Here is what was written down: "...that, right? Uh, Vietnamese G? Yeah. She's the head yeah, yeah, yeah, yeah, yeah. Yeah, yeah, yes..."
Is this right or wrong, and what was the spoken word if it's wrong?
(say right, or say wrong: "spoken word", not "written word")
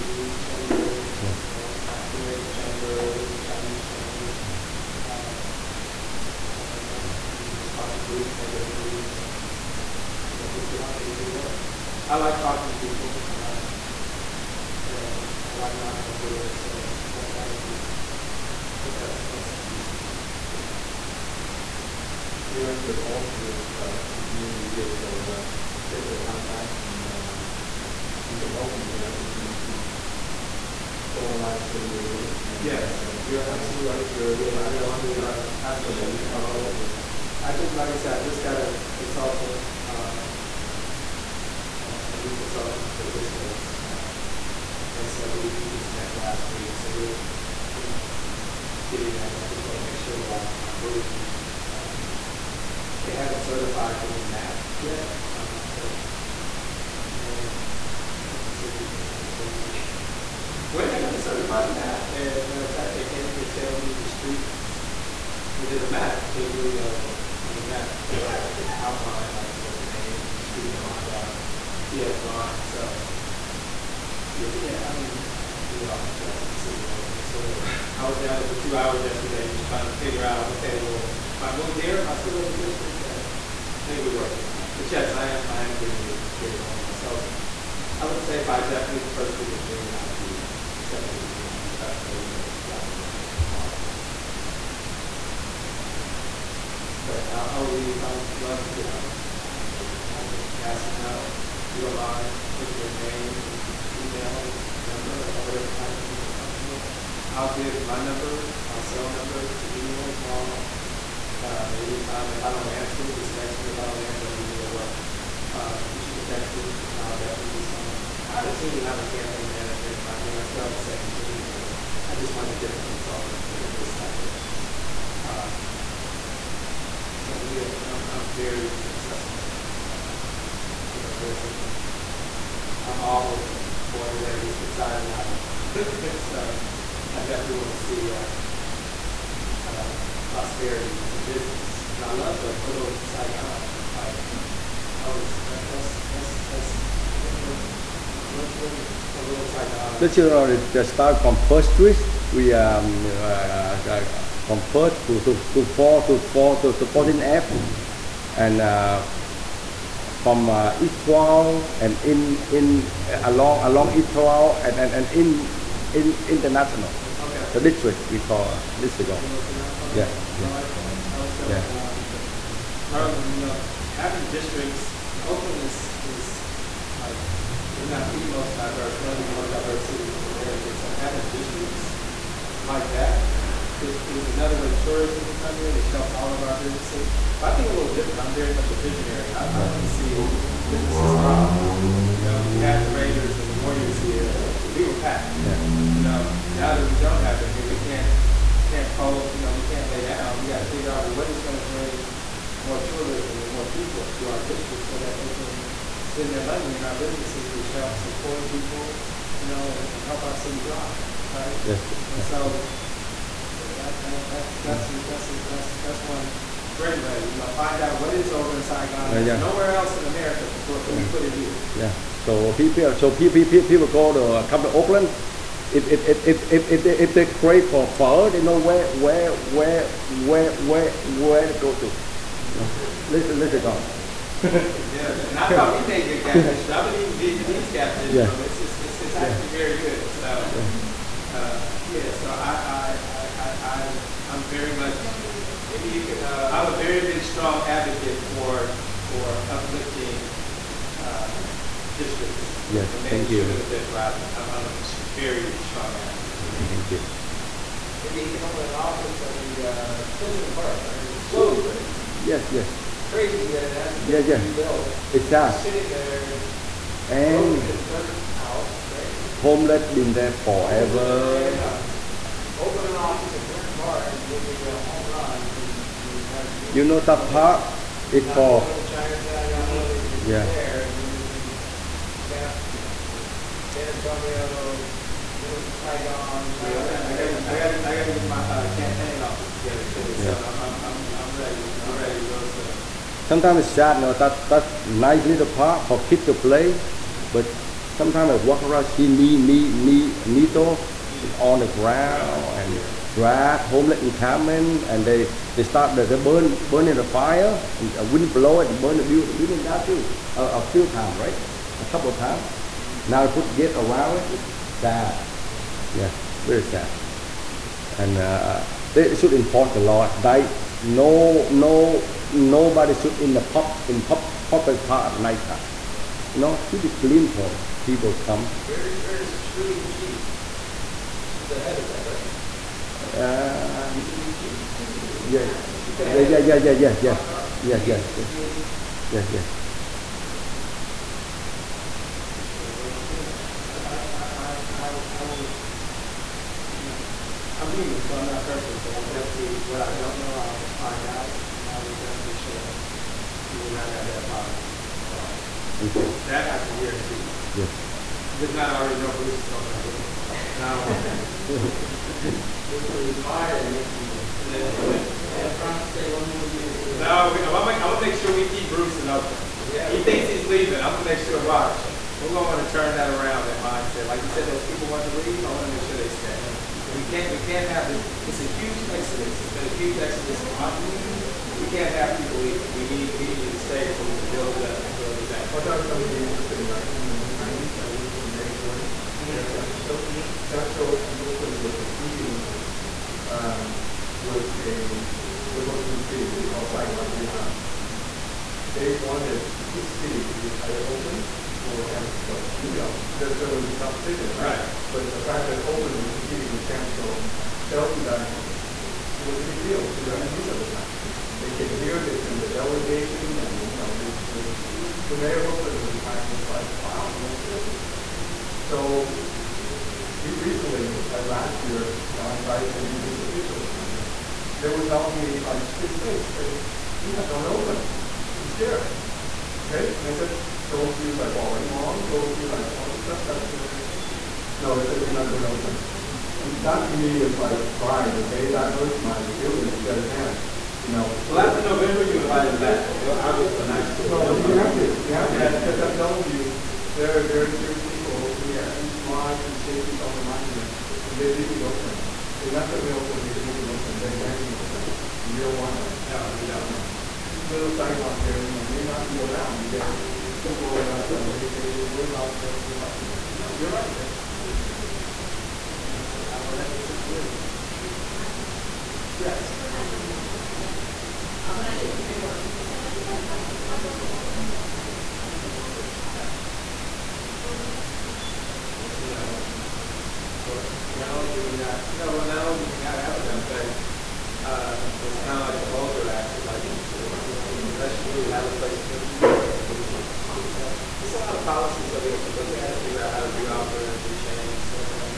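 wrong: "Shirley", not "Vietnamese".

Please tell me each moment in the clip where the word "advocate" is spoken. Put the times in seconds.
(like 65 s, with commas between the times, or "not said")
247 s, 255 s.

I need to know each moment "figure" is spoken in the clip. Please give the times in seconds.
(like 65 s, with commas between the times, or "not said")
80 s, 200 s, 492 s.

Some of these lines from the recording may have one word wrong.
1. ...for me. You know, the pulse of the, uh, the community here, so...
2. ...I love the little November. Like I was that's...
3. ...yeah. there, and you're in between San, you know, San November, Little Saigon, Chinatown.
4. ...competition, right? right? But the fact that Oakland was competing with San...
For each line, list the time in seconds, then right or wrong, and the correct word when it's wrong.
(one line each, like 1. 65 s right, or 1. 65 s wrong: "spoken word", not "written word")
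1. 19 s right
2. 142 s wrong: "Saigon", not "November"
3. 280 s wrong: "Antonio", not "November"
4. 403 s right.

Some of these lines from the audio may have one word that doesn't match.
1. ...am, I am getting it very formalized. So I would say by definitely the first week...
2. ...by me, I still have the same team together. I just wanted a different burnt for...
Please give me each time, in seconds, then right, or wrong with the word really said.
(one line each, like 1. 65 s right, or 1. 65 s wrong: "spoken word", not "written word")
1. 85 s right
2. 120 s wrong: "consultant", not "burnt".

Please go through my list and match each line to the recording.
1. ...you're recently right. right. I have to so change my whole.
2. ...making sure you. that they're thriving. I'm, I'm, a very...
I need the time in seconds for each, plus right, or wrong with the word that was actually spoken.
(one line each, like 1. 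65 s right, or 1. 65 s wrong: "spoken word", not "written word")
1. 34 s wrong: "absolutely", not "recently"
2. 253 s right.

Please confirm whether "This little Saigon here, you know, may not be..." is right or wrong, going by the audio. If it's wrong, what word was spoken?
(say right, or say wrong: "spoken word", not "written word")
right.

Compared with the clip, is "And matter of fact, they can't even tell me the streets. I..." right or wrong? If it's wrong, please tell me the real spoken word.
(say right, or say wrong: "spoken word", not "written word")
right.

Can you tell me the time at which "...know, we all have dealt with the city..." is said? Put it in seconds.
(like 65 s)
75 s.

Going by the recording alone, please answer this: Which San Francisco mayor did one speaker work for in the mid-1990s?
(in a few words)
Mayor Jordan.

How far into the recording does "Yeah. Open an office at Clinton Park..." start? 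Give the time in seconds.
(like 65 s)
271 s.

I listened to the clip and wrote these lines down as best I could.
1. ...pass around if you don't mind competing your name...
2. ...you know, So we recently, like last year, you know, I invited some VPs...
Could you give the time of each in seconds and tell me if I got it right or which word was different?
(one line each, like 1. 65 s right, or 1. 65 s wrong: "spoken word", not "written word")
1. 100 s wrong: "putting", not "competing"
2. 417 s right.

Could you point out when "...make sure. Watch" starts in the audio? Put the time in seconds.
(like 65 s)
371 s.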